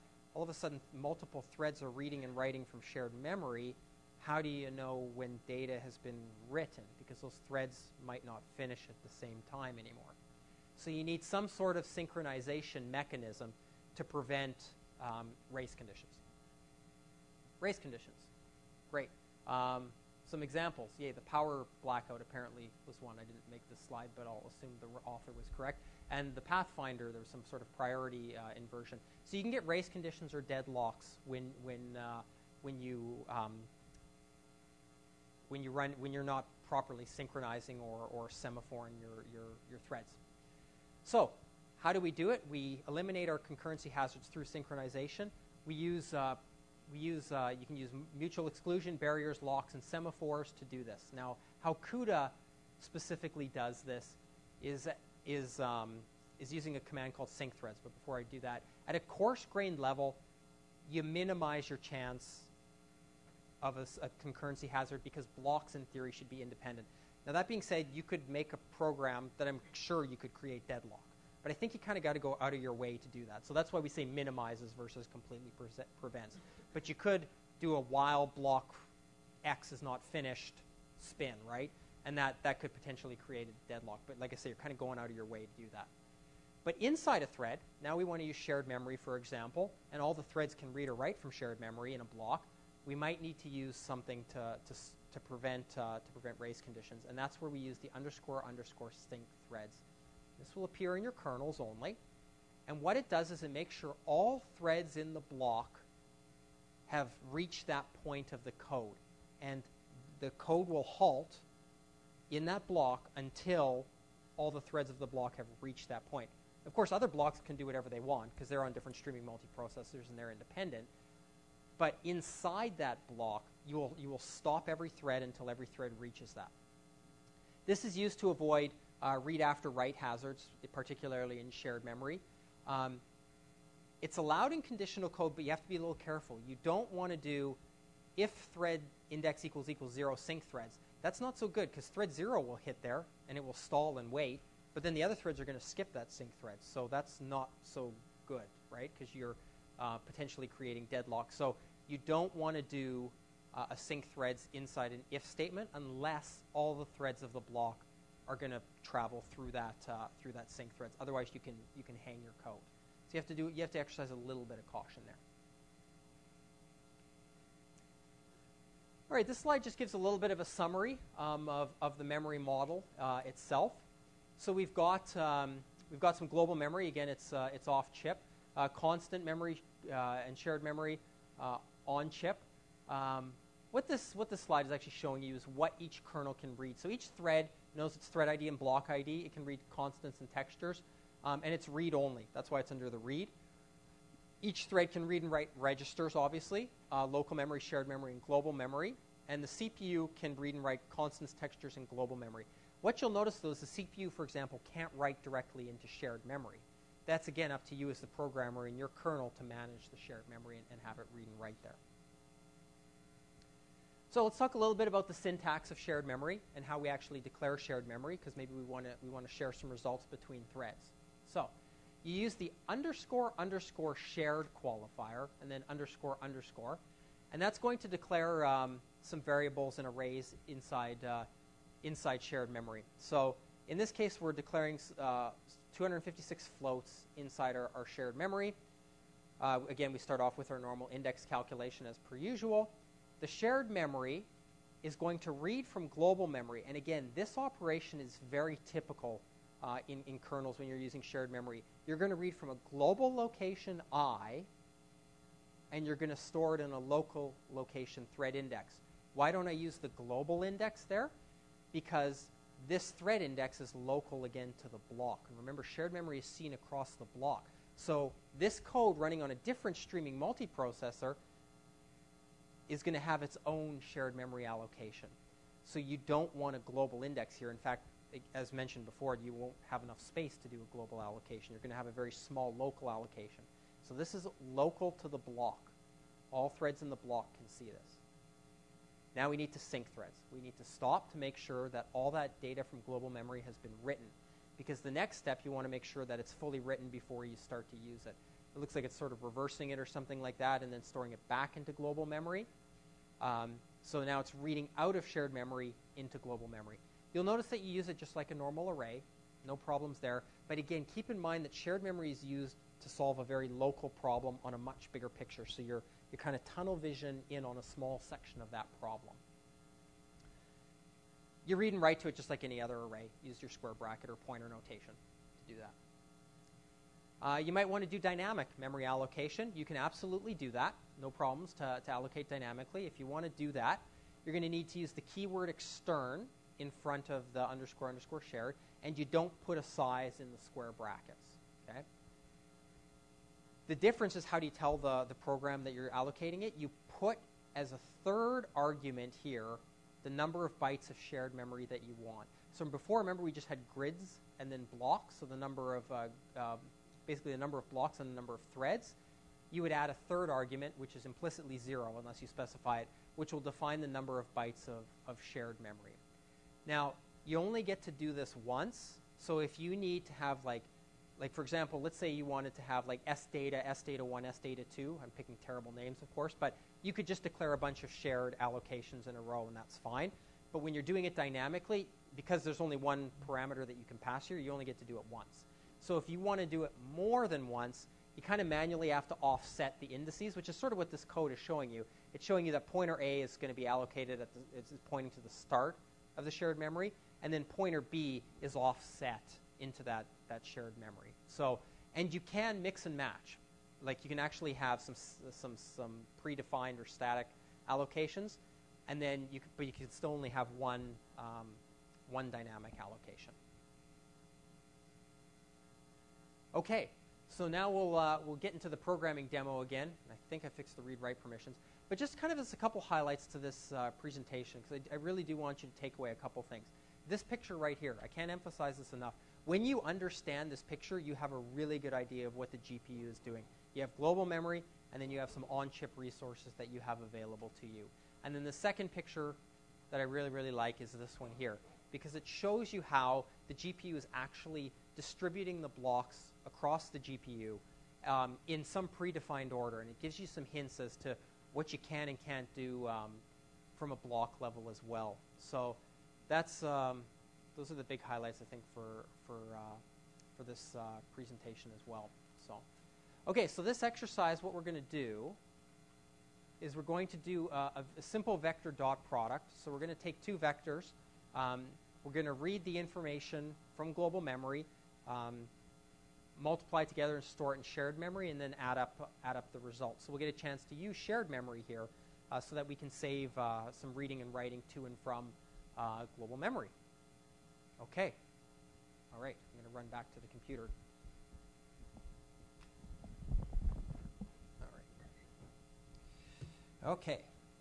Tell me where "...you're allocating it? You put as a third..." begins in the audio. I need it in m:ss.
5:45.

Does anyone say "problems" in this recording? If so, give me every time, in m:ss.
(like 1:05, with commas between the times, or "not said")
5:09, 5:13, 5:18, 5:31.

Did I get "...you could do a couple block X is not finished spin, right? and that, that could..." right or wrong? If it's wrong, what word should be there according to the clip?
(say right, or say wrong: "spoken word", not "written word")
wrong: "while", not "couple".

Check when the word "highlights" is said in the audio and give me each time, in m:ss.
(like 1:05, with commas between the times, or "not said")
7:02, 7:38.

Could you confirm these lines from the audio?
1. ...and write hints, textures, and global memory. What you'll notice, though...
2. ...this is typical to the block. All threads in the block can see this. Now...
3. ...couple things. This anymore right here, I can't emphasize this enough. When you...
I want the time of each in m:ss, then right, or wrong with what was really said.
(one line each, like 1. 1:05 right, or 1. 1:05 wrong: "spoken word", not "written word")
1. 3:20 wrong: "constants", not "hints"
2. 4:43 wrong: "local", not "typical"
3. 7:06 wrong: "picture", not "anymore".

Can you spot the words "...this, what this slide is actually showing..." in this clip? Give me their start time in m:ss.
3:03.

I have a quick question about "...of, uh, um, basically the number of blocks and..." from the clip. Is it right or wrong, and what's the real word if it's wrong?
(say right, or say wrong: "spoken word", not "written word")
right.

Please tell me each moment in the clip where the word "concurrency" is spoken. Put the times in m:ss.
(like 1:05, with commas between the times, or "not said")
0:43, 1:04.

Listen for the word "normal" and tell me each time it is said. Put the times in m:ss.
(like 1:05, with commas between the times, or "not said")
4:00, 5:08.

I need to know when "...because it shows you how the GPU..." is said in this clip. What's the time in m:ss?
7:21.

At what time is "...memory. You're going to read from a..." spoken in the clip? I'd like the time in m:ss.
4:11.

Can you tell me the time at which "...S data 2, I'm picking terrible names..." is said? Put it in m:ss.
6:14.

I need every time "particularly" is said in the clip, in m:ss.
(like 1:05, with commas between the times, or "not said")
2:10.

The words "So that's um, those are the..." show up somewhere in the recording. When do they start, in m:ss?
7:35.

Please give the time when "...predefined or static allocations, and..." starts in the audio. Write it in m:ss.
6:46.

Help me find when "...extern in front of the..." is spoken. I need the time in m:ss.
5:35.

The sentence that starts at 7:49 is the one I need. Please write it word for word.
So we're going to take two vectors.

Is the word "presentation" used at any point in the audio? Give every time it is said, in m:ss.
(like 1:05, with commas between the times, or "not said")
7:03, 7:41.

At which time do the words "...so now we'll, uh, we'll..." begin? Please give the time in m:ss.
6:57.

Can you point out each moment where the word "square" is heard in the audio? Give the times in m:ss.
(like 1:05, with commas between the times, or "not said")
5:23, 5:40.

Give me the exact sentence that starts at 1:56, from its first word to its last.
Of course, other blocks can do whatever they want because they're on different streaming multiprocessors and they're independent.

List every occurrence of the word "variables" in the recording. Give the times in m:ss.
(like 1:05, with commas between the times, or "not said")
3:49.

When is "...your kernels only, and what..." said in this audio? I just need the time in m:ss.
1:41.